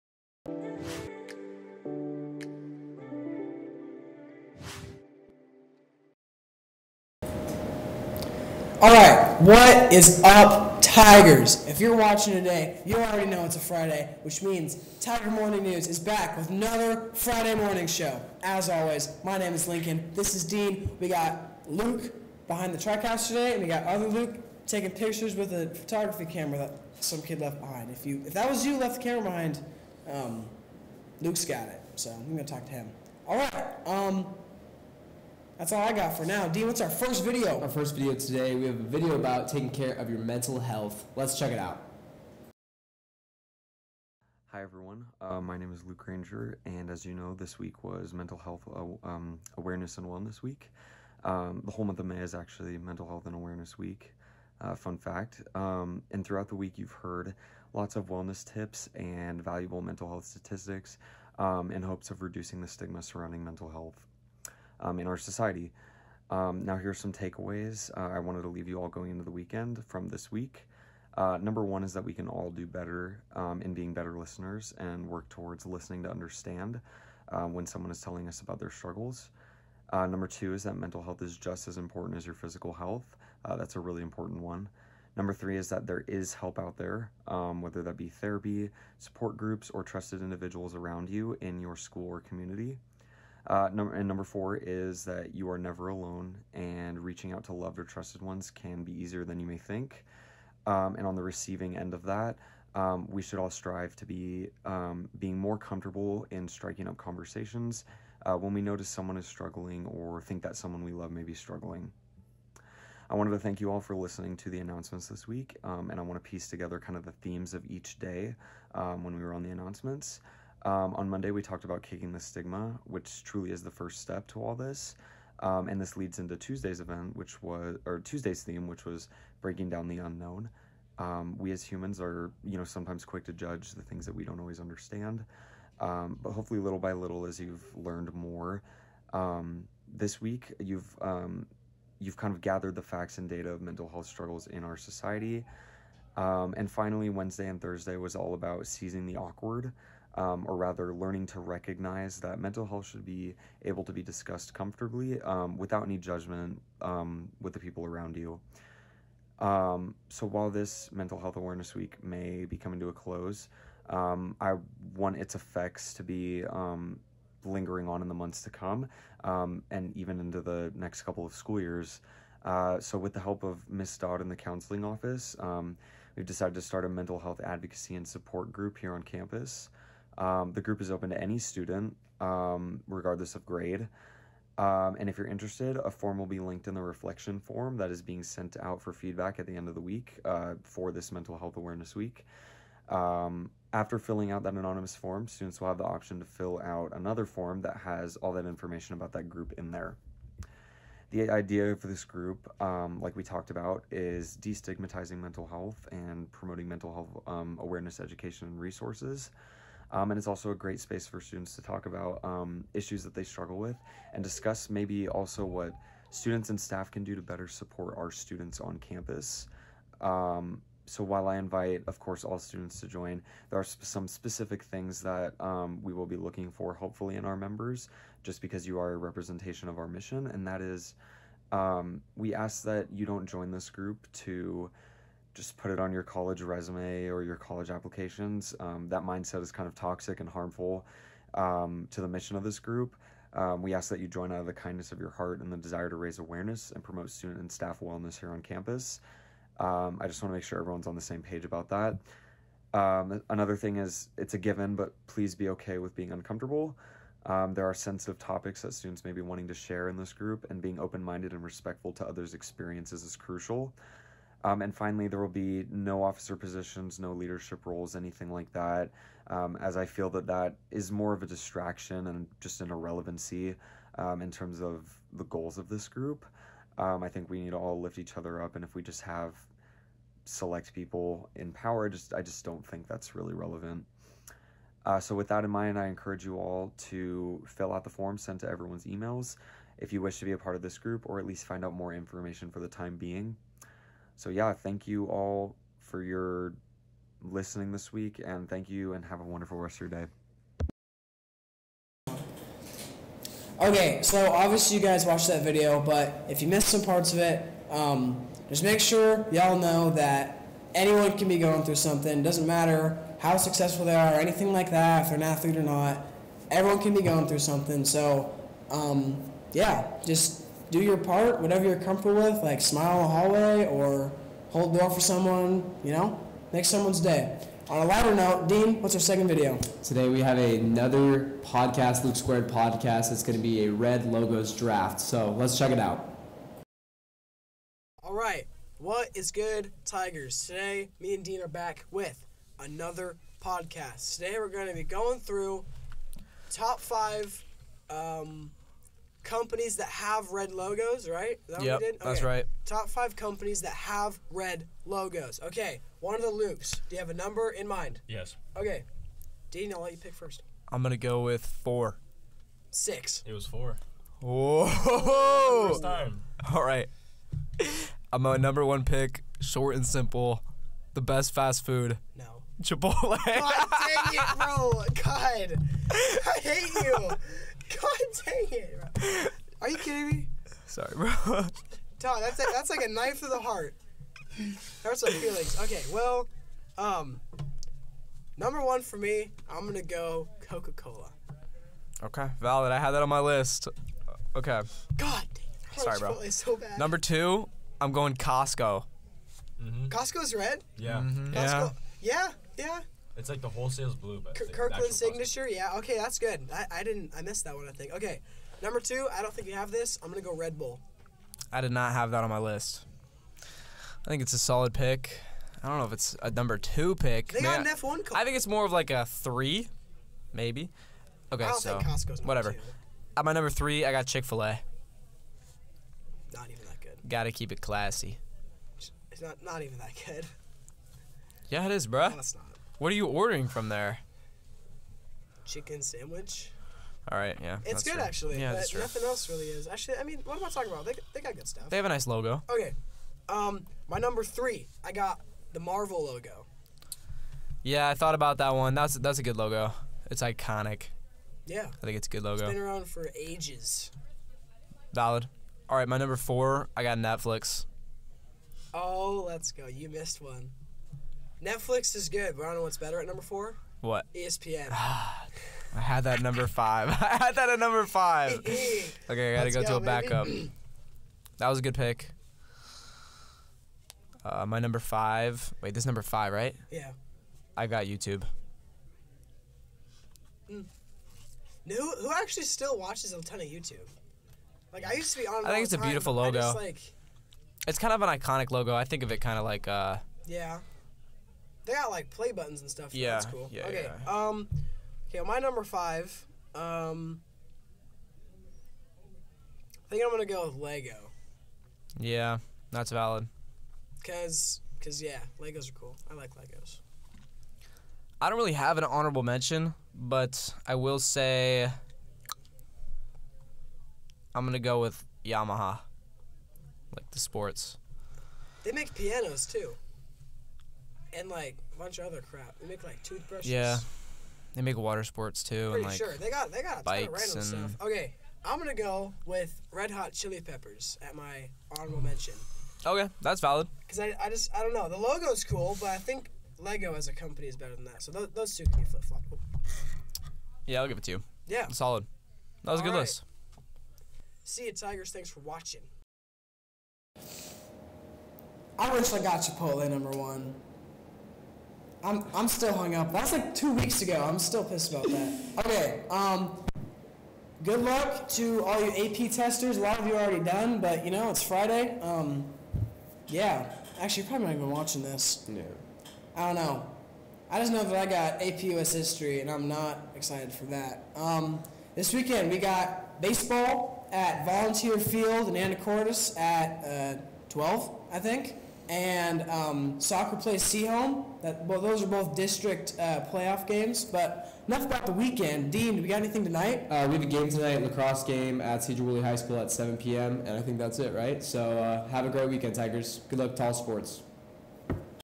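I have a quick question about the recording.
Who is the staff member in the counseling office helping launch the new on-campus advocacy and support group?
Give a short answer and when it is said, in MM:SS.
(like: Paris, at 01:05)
Ms. Dodd, at 02:53.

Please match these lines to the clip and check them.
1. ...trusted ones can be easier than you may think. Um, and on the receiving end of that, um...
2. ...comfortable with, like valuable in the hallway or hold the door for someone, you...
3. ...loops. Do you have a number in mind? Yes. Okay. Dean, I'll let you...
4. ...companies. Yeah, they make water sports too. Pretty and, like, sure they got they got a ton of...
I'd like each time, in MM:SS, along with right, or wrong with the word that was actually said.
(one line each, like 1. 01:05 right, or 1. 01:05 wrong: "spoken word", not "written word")
1. 01:37 right
2. 05:21 wrong: "smile", not "valuable"
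3. 05:56 right
4. 08:43 wrong: "toothbrushes", not "companies".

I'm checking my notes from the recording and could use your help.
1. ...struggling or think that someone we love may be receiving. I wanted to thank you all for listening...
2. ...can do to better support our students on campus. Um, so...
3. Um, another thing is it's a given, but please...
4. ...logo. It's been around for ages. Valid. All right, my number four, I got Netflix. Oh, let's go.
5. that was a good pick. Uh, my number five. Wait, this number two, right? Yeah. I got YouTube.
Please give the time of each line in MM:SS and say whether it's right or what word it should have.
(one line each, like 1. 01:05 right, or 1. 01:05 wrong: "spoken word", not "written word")
1. 01:49 wrong: "struggling", not "receiving"
2. 03:36 right
3. 04:12 right
4. 07:32 right
5. 07:51 wrong: "five", not "two".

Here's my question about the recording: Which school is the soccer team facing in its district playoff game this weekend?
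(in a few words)
Sehome.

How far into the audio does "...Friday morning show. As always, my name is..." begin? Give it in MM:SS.
00:17.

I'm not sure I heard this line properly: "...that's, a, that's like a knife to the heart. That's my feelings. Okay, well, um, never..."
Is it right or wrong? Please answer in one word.
wrong.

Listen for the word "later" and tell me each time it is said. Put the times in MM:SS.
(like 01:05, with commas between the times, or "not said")
not said.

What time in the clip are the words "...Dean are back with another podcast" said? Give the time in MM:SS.
05:41.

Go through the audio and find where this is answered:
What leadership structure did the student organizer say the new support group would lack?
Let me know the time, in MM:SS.
04:26.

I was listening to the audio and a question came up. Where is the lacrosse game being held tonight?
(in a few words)
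Sedro-Woolley High School.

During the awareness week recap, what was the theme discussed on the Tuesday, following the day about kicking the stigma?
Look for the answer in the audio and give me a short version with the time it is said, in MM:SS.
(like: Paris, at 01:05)
Breaking down the unknown, at 02:09.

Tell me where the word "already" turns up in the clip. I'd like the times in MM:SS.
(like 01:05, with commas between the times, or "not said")
00:12, 09:20.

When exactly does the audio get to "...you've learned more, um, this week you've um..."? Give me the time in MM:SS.
02:17.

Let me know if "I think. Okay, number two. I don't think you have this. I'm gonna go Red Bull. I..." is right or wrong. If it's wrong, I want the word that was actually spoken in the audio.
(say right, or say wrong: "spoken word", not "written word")
right.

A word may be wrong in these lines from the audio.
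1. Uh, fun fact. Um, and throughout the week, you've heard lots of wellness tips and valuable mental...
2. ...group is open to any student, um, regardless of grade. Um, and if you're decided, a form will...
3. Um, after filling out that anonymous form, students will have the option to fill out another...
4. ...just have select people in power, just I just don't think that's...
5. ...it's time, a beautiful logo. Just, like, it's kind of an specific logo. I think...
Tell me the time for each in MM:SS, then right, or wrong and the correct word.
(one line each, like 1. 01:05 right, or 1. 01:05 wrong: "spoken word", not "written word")
1. 00:54 right
2. 03:00 wrong: "interested", not "decided"
3. 03:12 right
4. 04:38 right
5. 08:05 wrong: "iconic", not "specific".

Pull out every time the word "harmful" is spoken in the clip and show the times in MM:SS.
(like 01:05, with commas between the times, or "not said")
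04:00.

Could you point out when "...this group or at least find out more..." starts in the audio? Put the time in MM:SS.
04:50.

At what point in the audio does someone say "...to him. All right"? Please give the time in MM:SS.
00:32.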